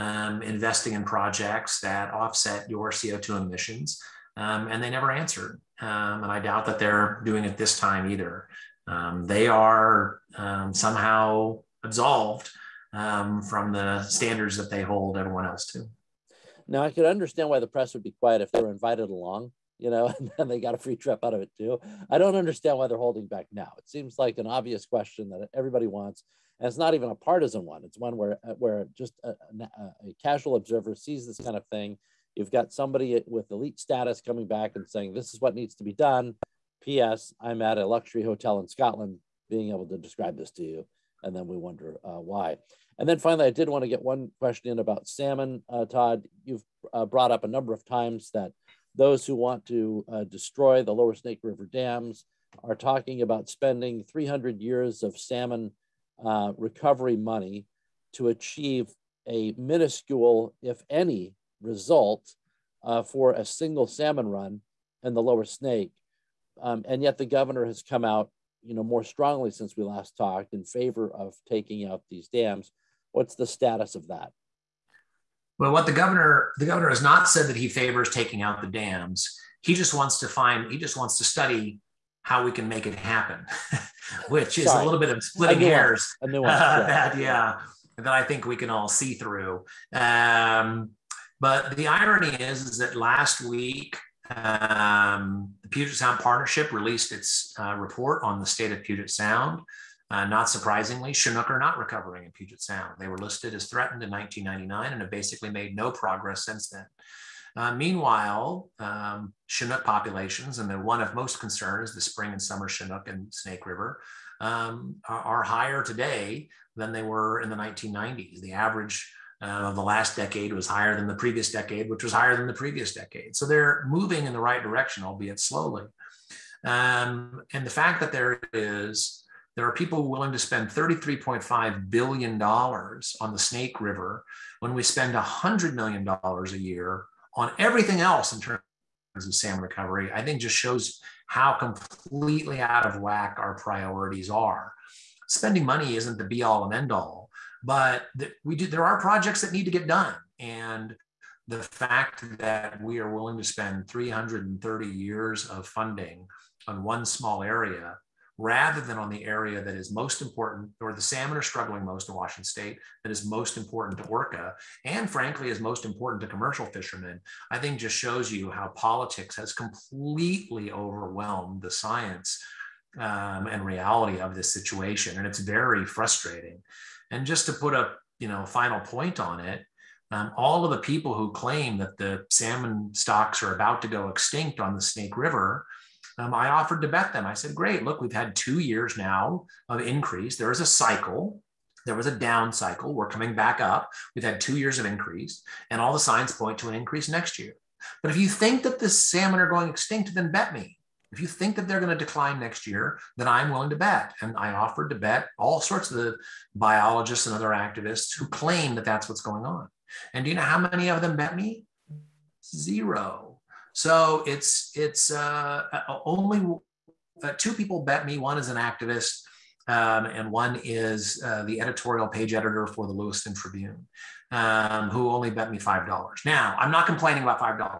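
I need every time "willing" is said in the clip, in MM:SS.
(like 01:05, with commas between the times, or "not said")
02:10, 02:33, 03:23.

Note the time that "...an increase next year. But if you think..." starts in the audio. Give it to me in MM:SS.
03:16.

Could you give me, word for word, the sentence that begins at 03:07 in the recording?
I said, great, look, we've had two years now of increase.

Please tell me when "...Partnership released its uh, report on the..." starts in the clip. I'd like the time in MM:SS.
01:36.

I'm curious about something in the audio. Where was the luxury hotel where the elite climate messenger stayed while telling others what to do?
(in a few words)
Scotland.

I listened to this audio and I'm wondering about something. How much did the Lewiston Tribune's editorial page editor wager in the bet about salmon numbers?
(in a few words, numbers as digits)
$5.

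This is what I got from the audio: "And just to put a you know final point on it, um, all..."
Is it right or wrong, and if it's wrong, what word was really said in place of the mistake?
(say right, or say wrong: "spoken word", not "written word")
right.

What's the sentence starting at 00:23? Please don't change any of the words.
It seems like an obvious question that everybody wants.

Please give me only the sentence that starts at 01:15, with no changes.
Well, what the governor the governor has not said that he favors taking out the dams.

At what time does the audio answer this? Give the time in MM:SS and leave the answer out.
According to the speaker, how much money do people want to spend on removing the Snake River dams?
02:10.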